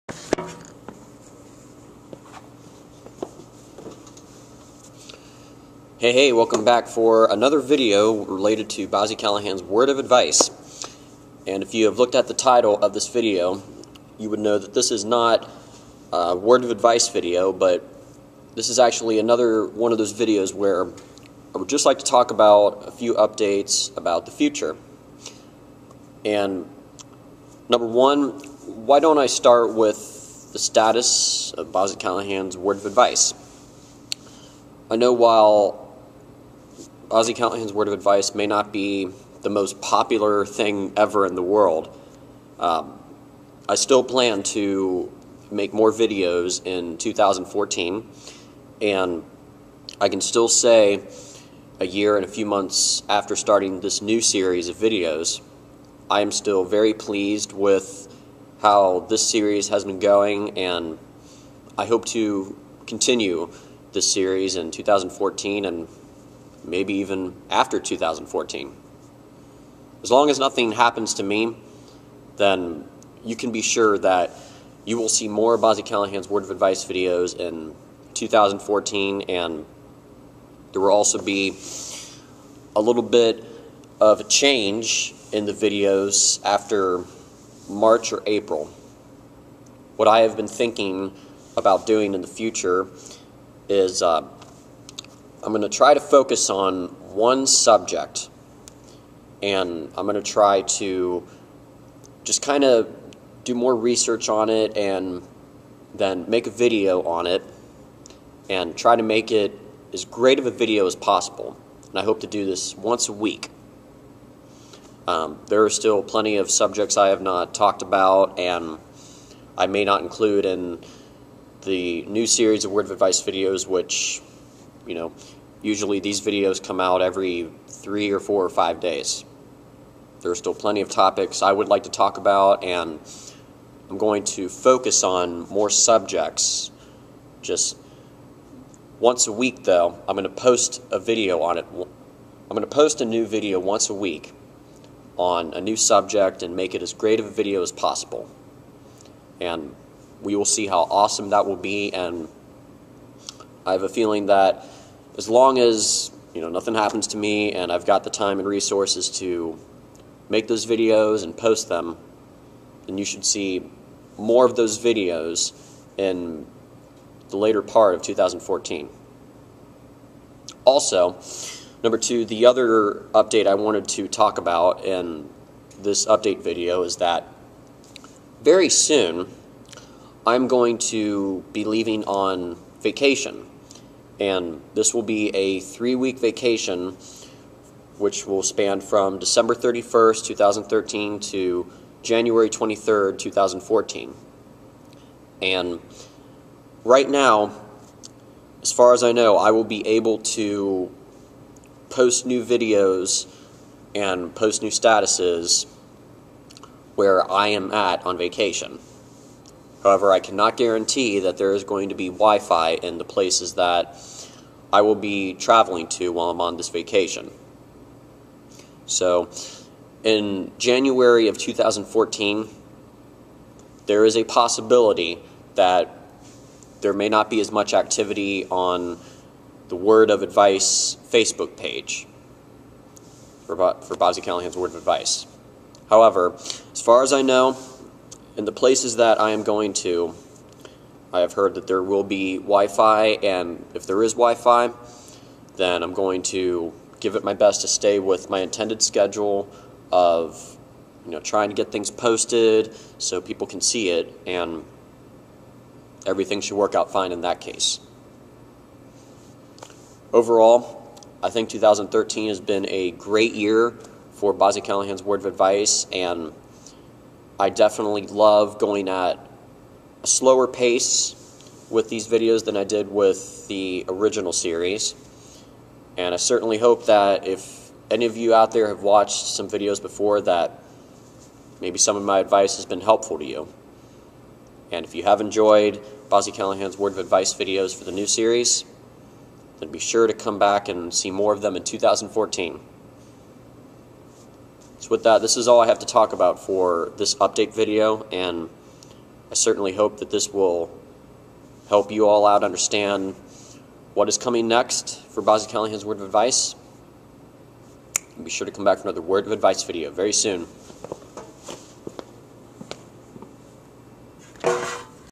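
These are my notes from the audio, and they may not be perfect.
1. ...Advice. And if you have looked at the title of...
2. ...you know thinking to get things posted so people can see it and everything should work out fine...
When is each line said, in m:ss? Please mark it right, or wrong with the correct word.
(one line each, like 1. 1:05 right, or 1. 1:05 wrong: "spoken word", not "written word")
1. 0:09 right
2. 4:11 wrong: "trying", not "thinking".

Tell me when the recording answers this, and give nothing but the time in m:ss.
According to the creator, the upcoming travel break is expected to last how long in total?
3:05.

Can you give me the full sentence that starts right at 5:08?
And be sure to come back for another Word of Advice video very soon.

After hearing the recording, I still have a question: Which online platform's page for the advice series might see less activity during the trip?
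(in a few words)
Facebook.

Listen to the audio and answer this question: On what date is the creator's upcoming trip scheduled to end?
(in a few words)
January 23rd, 2014.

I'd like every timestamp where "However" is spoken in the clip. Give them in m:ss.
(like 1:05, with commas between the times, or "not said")
3:29, 3:55.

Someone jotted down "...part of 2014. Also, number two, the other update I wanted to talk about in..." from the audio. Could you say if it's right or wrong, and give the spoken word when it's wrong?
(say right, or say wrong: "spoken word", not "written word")
right.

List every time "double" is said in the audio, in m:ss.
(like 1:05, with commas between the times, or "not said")
not said.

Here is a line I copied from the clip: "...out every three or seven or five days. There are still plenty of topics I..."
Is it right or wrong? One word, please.
wrong.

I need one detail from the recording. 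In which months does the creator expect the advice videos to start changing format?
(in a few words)
March or April.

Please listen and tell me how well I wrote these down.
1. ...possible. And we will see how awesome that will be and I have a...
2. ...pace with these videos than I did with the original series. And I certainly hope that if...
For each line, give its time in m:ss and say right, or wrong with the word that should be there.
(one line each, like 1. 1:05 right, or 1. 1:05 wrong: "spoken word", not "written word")
1. 2:27 right
2. 4:30 right.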